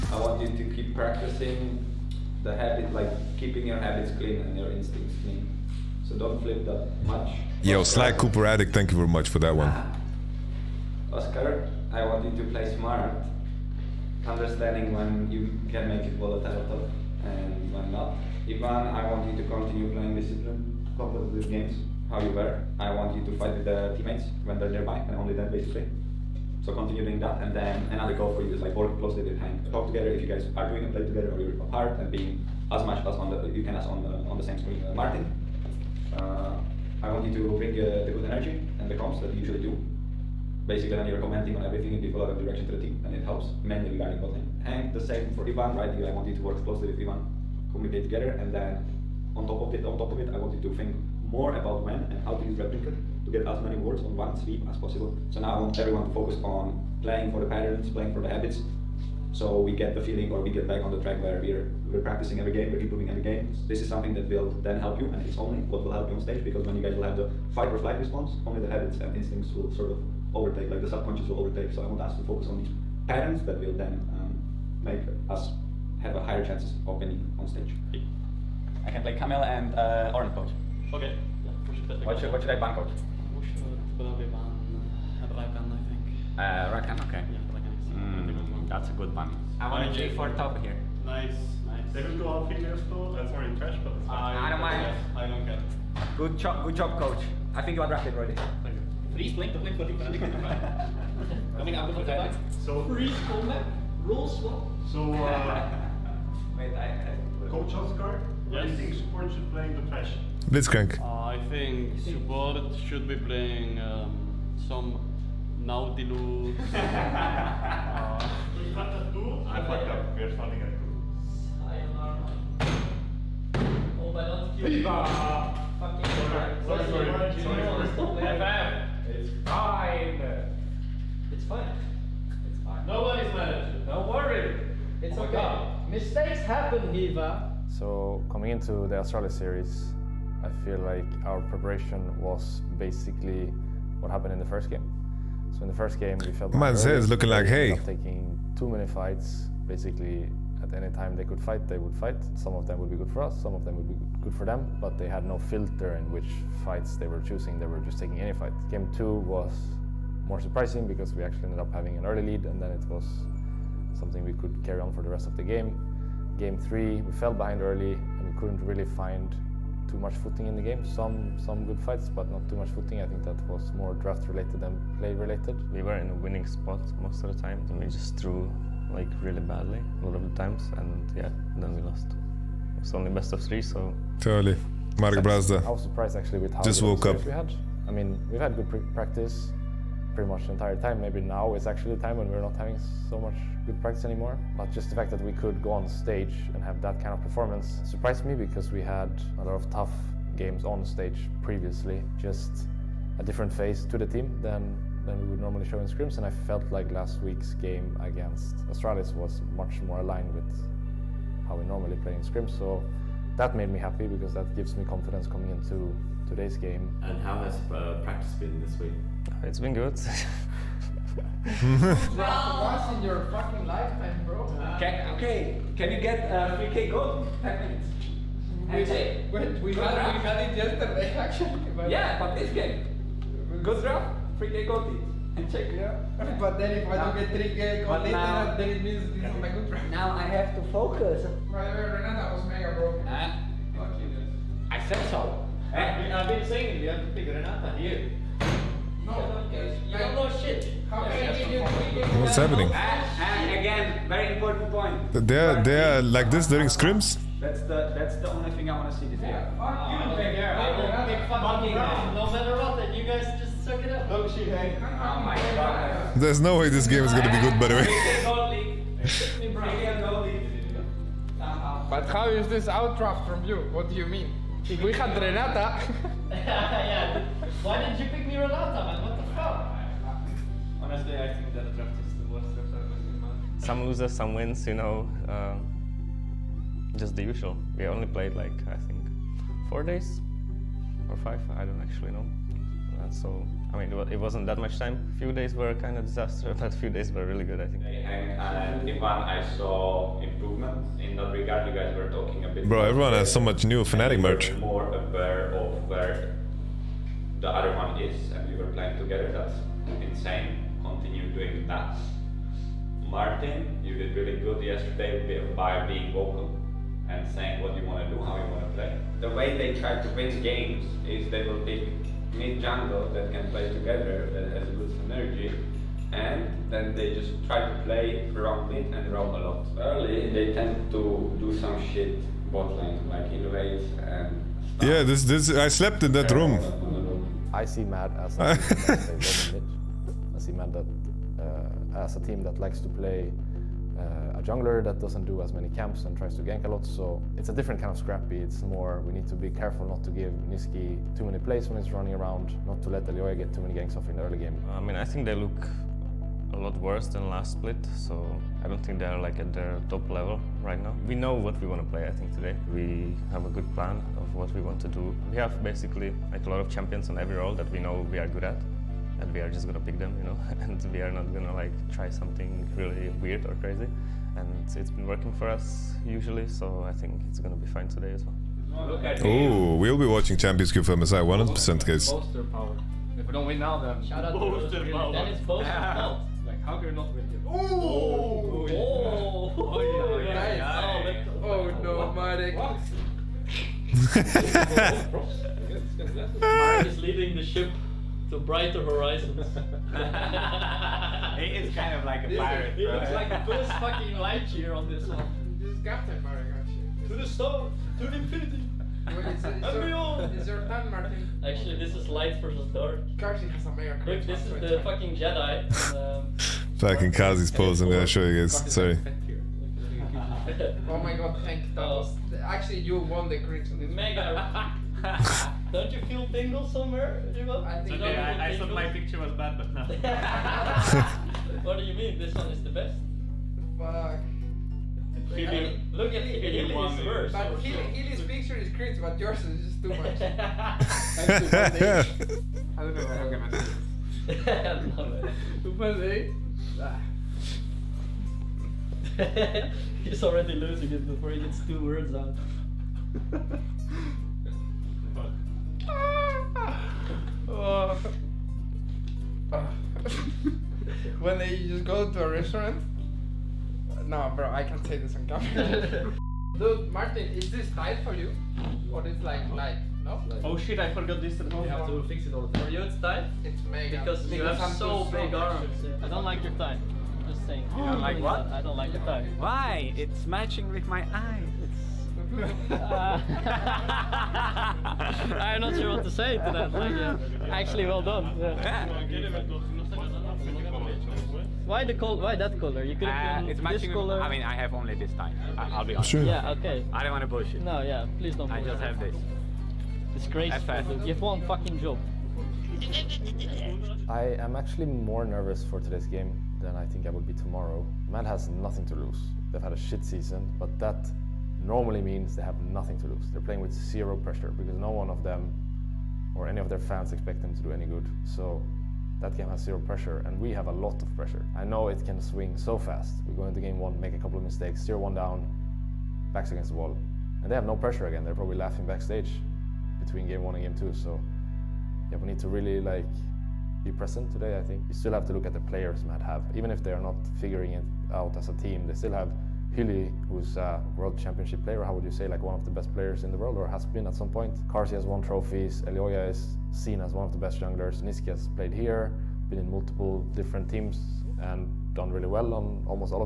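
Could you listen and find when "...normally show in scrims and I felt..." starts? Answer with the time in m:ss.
3:25.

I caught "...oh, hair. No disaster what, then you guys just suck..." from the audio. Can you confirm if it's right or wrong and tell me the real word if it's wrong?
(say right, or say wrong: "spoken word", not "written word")
wrong: "matter", not "disaster".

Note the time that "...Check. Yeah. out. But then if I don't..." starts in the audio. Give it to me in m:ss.
3:55.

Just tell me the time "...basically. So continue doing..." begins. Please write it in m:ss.
0:25.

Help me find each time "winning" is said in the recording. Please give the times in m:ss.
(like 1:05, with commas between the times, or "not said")
1:16, 2:56.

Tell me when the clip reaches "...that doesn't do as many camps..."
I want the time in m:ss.
5:44.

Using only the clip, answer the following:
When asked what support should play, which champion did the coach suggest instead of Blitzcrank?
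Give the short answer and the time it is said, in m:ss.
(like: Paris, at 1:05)
Nautilus, at 1:55.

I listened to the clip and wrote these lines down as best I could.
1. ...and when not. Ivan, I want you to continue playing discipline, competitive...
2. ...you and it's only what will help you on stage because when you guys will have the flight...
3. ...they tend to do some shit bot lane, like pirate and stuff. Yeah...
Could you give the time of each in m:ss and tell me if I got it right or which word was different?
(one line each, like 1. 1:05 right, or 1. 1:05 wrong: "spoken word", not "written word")
1. 0:17 right
2. 1:04 wrong: "fight", not "flight"
3. 5:30 wrong: "innovate", not "pirate".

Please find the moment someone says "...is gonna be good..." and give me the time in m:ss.
4:27.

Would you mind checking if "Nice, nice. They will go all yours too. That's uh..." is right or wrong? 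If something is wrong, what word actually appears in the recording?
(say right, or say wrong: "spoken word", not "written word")
wrong: "fingers", not "yours".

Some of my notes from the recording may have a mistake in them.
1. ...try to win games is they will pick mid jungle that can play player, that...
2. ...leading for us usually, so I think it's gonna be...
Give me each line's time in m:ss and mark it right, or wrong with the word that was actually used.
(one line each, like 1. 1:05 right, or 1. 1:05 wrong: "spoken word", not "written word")
1. 5:19 wrong: "together", not "player"
2. 6:15 wrong: "working", not "leading".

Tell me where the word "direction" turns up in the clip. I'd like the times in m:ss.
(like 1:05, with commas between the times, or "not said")
0:42.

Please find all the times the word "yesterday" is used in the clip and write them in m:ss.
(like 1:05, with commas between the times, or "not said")
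3:50, 5:14.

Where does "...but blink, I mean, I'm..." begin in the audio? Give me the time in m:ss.
1:39.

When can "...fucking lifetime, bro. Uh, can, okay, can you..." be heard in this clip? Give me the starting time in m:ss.
3:43.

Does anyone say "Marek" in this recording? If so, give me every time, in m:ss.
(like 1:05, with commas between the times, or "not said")
6:32, 6:36.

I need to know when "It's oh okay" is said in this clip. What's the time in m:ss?
2:15.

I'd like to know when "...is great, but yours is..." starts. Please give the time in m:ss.
7:18.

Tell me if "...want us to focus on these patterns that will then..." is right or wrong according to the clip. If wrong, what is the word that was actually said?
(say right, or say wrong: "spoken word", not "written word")
right.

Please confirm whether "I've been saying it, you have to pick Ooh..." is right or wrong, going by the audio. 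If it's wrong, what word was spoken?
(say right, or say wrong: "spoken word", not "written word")
wrong: "Renata", not "Ooh".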